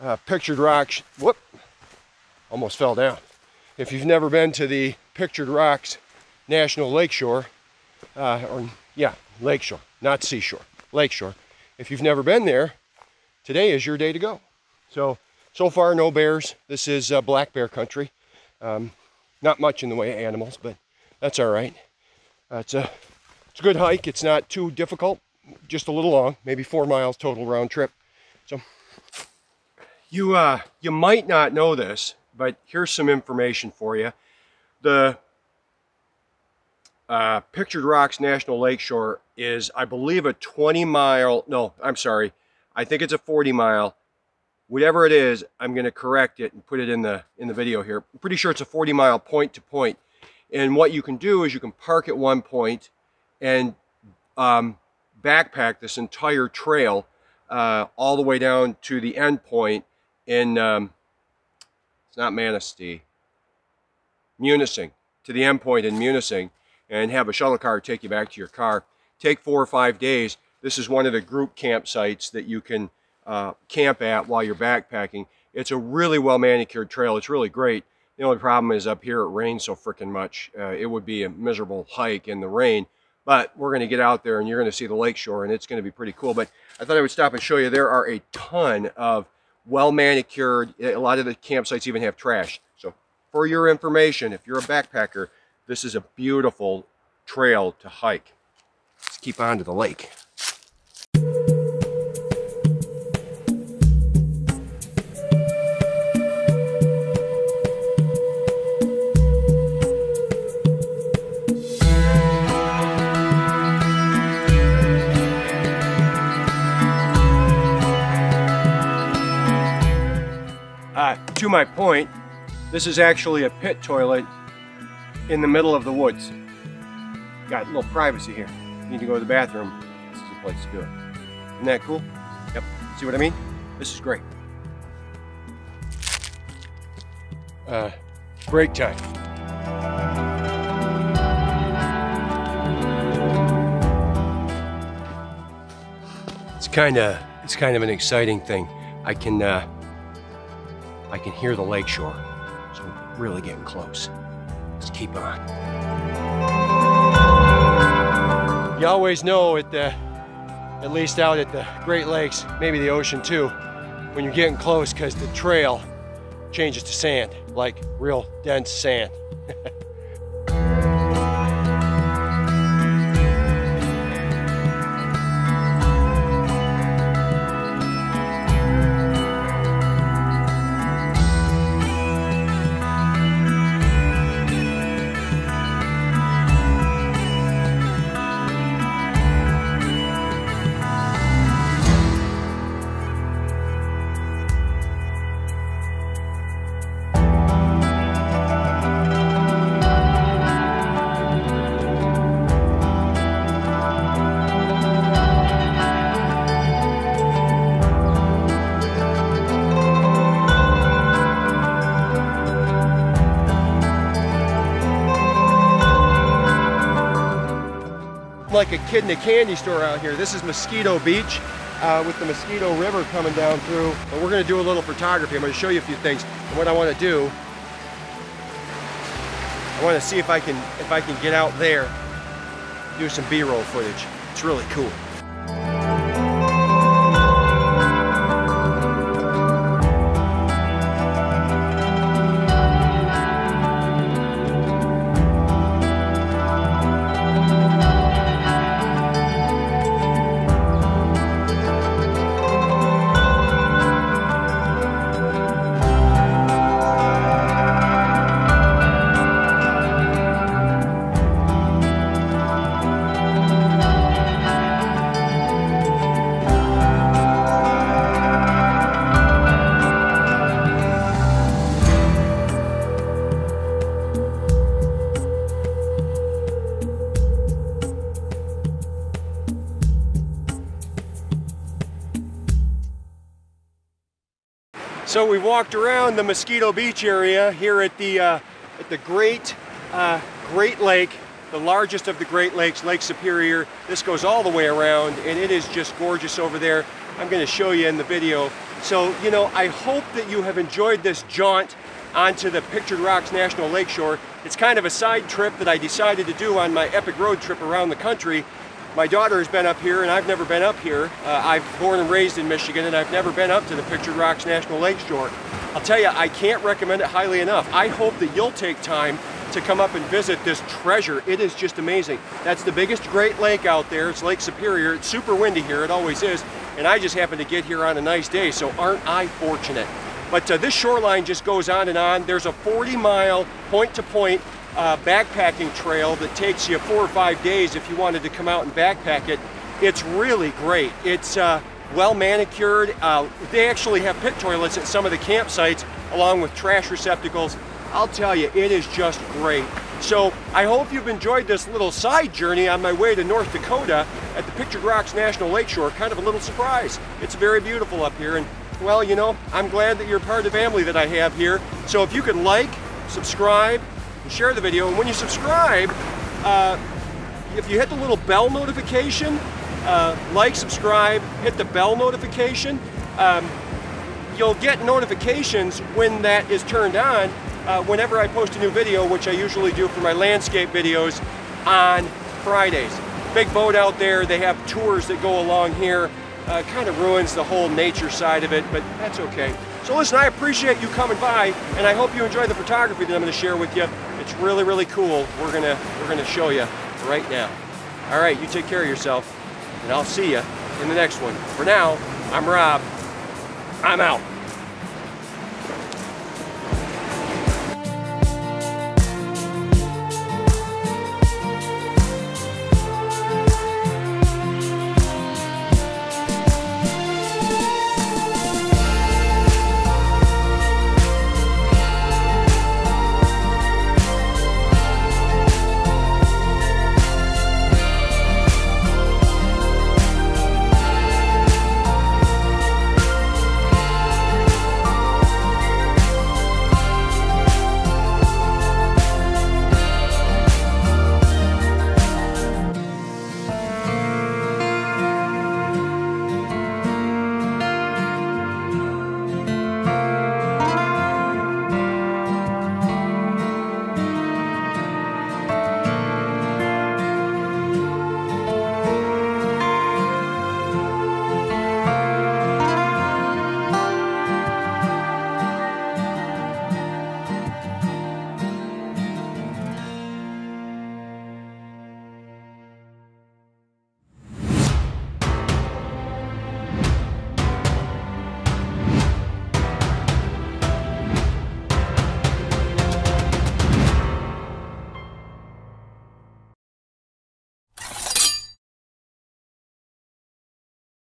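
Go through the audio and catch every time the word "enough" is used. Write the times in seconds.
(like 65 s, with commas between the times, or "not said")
317 s.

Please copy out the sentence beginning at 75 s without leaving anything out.
It's a really well manicured trail.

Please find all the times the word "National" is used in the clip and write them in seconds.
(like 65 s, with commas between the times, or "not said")
6 s, 38 s, 303 s, 314 s, 355 s.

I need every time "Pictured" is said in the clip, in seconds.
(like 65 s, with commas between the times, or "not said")
0 s, 5 s, 37 s, 302 s, 313 s, 354 s.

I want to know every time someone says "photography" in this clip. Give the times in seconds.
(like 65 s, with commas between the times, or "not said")
224 s, 392 s.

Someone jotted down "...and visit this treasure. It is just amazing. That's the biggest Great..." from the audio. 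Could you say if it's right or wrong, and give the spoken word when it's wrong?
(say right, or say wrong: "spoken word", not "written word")
right.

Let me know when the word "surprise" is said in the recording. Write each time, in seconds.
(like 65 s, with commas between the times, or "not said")
356 s.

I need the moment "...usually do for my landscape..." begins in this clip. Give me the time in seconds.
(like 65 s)
379 s.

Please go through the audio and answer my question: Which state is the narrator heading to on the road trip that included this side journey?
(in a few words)
North Dakota.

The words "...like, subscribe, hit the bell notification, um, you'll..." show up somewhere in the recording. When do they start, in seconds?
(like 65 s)
370 s.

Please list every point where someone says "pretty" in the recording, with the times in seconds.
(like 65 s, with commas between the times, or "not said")
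48 s, 85 s.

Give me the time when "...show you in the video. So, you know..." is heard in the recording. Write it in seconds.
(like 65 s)
297 s.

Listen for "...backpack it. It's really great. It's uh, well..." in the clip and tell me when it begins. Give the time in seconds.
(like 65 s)
338 s.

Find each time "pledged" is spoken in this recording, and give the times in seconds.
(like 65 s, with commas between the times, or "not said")
not said.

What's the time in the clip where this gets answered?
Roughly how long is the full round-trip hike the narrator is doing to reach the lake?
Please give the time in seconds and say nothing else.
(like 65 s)
26 s.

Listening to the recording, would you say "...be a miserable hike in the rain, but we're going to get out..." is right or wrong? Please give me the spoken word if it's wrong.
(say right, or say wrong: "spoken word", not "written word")
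right.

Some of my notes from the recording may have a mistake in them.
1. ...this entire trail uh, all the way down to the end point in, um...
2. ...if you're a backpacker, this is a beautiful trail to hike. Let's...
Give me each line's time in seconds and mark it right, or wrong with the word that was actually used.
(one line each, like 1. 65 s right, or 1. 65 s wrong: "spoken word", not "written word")
1. 55 s right
2. 94 s right.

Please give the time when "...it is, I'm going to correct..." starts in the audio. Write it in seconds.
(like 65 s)
45 s.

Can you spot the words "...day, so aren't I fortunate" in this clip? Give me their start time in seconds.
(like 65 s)
328 s.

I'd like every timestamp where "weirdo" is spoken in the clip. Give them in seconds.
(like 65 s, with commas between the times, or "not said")
not said.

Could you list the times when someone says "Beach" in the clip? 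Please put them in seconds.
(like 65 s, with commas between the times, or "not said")
220 s, 286 s.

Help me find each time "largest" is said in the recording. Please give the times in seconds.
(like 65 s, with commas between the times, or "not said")
291 s.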